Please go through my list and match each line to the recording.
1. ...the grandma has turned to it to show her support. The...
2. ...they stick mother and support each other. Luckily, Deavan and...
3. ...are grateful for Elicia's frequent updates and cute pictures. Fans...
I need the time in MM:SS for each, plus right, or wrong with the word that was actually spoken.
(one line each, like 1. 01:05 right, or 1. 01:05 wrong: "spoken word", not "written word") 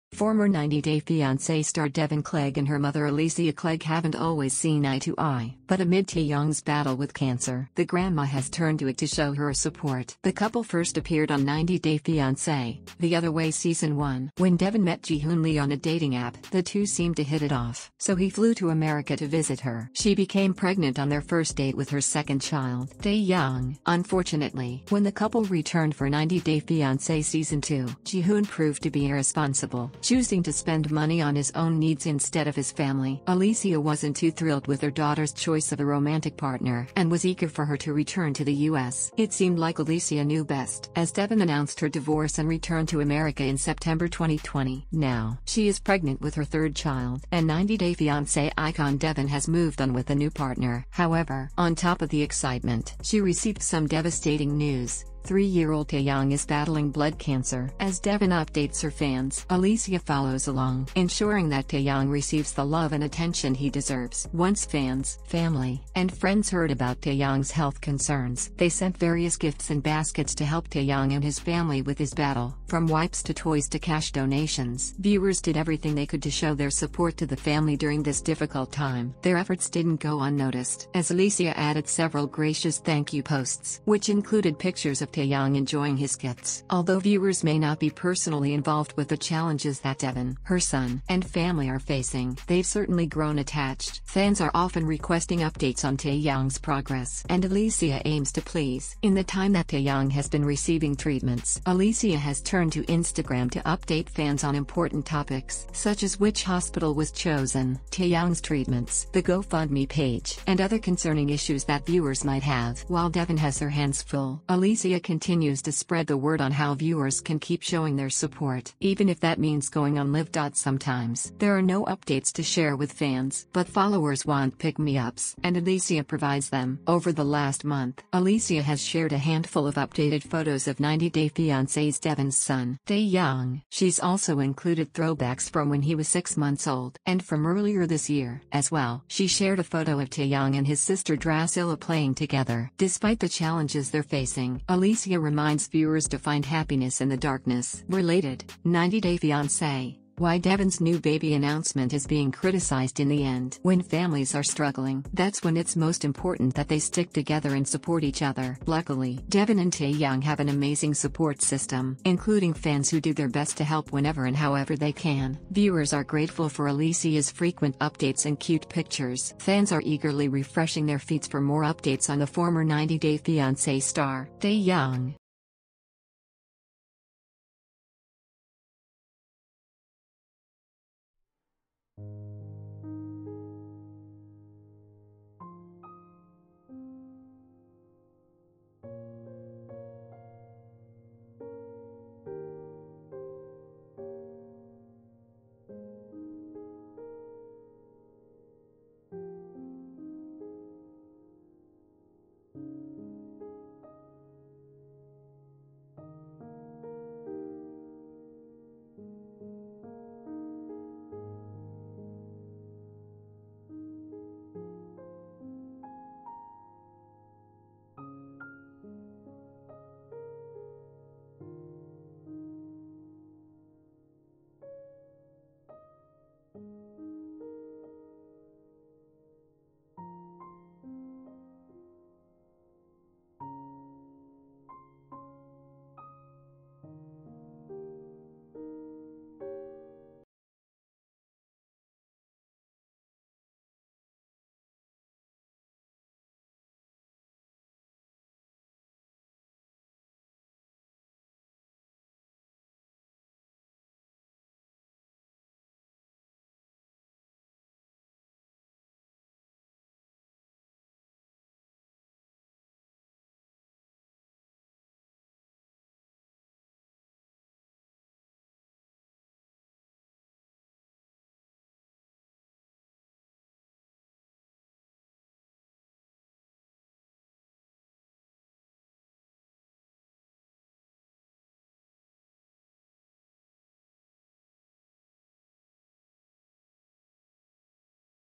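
1. 00:07 right
2. 02:36 wrong: "together", not "mother"
3. 02:45 right.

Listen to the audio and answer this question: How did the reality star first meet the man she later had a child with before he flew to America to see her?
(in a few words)
On a dating app.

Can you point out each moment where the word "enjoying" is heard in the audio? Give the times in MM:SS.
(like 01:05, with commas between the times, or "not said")
01:25.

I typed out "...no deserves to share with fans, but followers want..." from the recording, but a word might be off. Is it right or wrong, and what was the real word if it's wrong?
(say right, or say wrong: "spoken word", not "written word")
wrong: "updates", not "deserves".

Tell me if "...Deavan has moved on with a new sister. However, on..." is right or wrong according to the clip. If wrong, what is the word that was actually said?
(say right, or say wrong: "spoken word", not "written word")
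wrong: "partner", not "sister".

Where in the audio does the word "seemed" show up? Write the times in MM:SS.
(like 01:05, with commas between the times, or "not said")
00:16, 00:39.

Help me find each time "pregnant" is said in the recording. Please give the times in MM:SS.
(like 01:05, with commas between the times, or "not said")
00:20, 00:45.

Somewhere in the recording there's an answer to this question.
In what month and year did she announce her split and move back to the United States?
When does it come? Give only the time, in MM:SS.
00:43.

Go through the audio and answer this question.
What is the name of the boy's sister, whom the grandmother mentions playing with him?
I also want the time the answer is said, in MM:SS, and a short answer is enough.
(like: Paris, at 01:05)
Drascilla, at 02:21.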